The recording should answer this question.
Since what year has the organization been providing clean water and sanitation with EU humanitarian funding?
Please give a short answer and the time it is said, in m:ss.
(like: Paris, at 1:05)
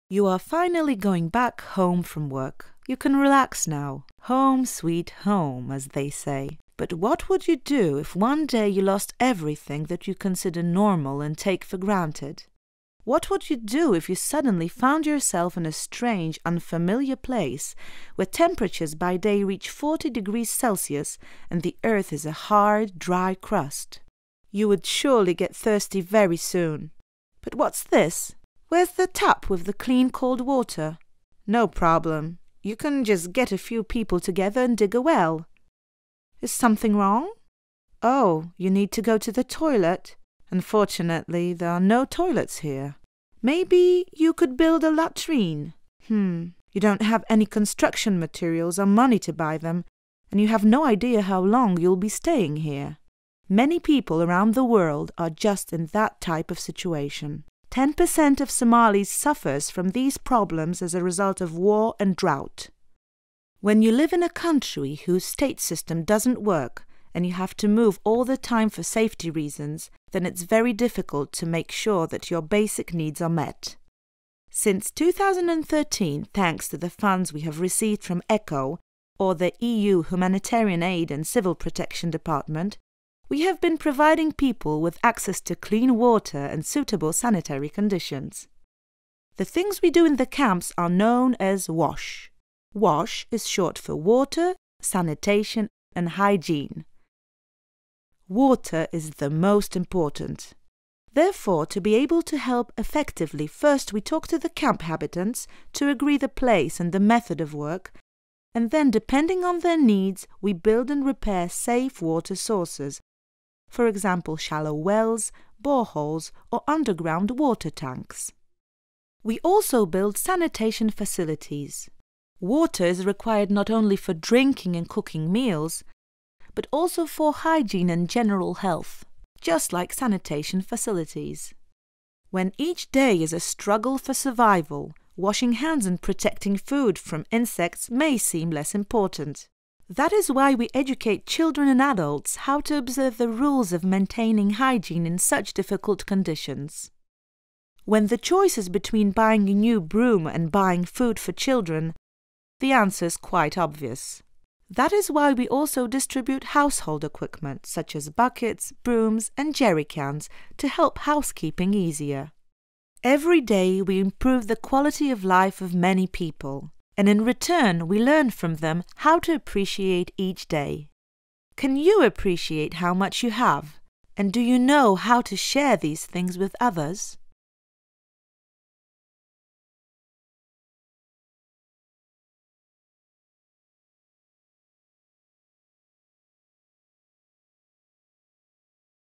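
2013, at 1:14.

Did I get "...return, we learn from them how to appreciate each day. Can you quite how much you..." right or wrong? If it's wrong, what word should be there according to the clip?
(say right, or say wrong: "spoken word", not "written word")
wrong: "appreciate", not "quite".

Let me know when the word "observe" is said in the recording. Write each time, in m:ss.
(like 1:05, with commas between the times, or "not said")
2:22.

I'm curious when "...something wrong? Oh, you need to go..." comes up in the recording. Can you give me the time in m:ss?
0:36.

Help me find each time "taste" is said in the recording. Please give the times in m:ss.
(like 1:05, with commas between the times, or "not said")
not said.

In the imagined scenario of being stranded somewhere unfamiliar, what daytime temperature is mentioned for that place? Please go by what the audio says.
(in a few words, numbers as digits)
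40 degrees Celsius.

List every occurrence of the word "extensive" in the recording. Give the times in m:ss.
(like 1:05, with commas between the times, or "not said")
not said.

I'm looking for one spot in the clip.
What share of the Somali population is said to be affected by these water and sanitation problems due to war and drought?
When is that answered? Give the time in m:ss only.
0:57.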